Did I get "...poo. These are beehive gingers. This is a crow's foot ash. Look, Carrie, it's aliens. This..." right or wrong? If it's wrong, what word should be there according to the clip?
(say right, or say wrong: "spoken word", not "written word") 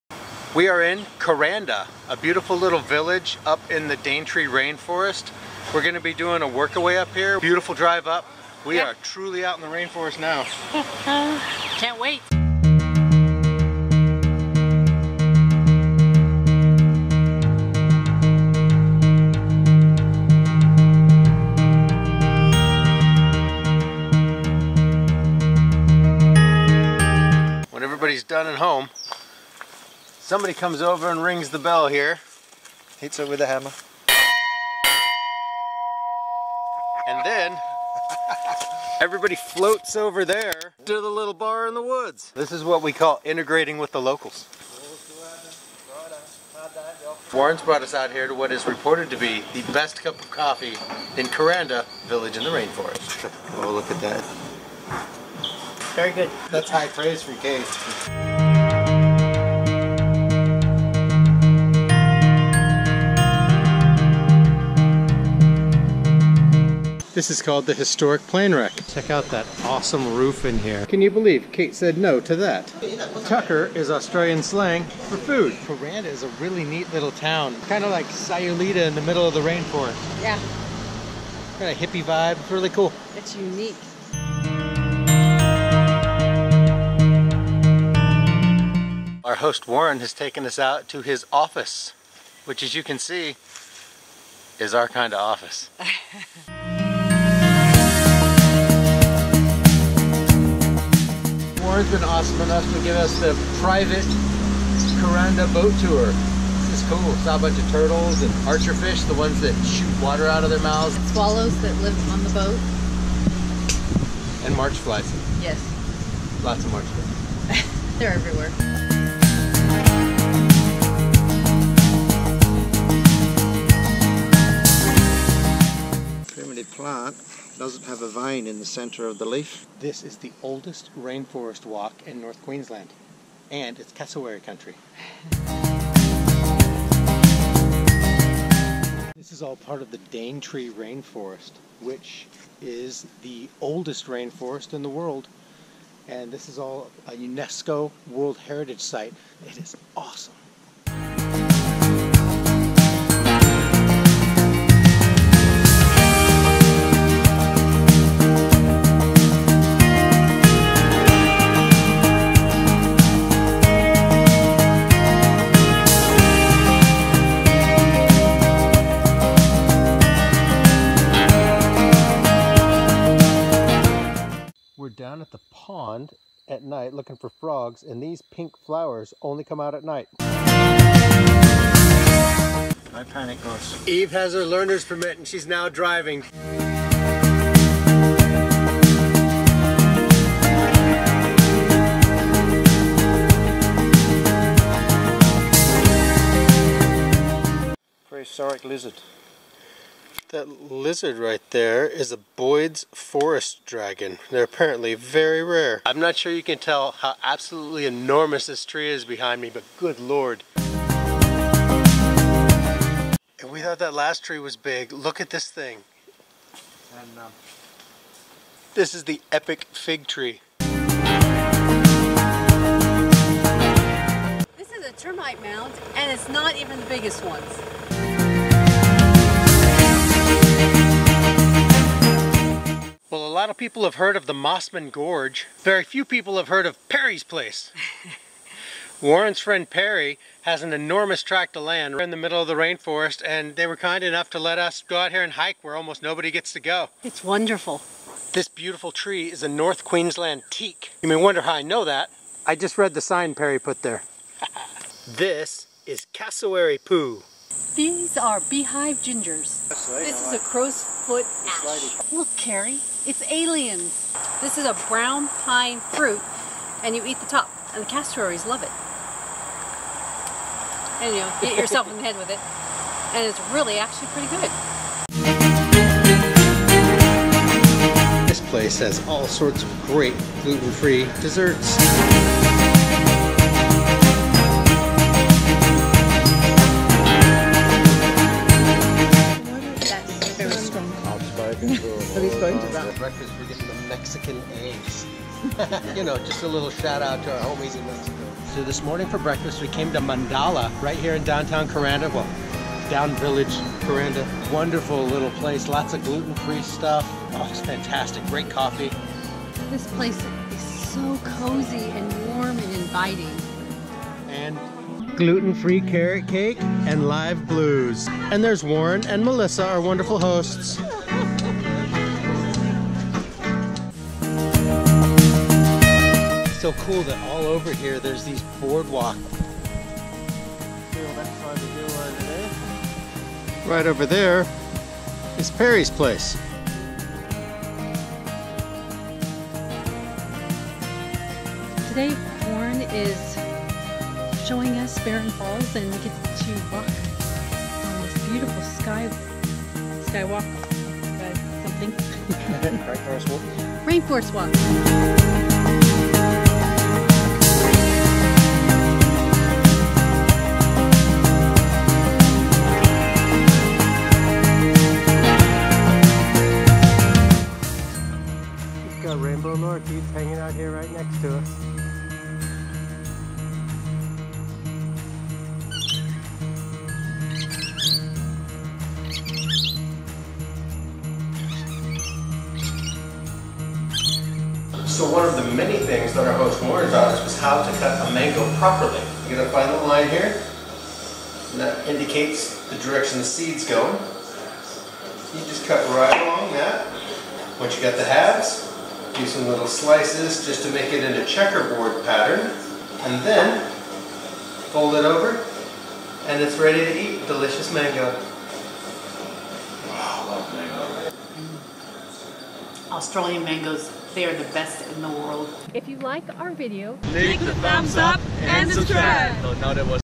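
right.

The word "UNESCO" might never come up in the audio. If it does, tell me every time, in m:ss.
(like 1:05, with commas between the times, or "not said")
2:27.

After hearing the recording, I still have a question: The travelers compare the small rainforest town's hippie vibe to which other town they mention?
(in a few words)
Sayulita.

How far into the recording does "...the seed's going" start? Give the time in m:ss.
6:33.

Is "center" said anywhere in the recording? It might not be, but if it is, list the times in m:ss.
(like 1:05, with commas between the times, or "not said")
2:08.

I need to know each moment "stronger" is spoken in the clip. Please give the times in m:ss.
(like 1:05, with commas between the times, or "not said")
not said.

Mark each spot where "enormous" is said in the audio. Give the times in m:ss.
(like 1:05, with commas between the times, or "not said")
3:27, 4:00.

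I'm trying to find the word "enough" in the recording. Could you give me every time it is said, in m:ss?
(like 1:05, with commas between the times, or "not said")
1:42, 4:04.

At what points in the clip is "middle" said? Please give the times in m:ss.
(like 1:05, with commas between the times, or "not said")
1:19, 4:02.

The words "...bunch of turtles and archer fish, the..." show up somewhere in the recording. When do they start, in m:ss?
1:47.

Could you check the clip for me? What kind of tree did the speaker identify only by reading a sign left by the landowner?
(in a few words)
North Queensland teak.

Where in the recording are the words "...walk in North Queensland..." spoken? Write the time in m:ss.
2:11.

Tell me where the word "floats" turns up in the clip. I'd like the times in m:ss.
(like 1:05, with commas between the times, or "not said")
0:39.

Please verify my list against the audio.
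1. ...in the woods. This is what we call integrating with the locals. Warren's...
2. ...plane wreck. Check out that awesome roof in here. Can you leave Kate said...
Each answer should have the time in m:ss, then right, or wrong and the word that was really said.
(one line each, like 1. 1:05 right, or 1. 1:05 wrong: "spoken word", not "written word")
1. 0:41 right
2. 1:08 wrong: "believe", not "leave".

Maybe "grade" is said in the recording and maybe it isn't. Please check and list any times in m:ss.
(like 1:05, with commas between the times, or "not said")
not said.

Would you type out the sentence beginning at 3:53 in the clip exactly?
Well, a lot of people have heard of the Mossman Gorge.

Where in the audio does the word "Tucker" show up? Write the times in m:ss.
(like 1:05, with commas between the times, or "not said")
1:13.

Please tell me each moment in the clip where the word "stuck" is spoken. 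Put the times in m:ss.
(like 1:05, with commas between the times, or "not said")
not said.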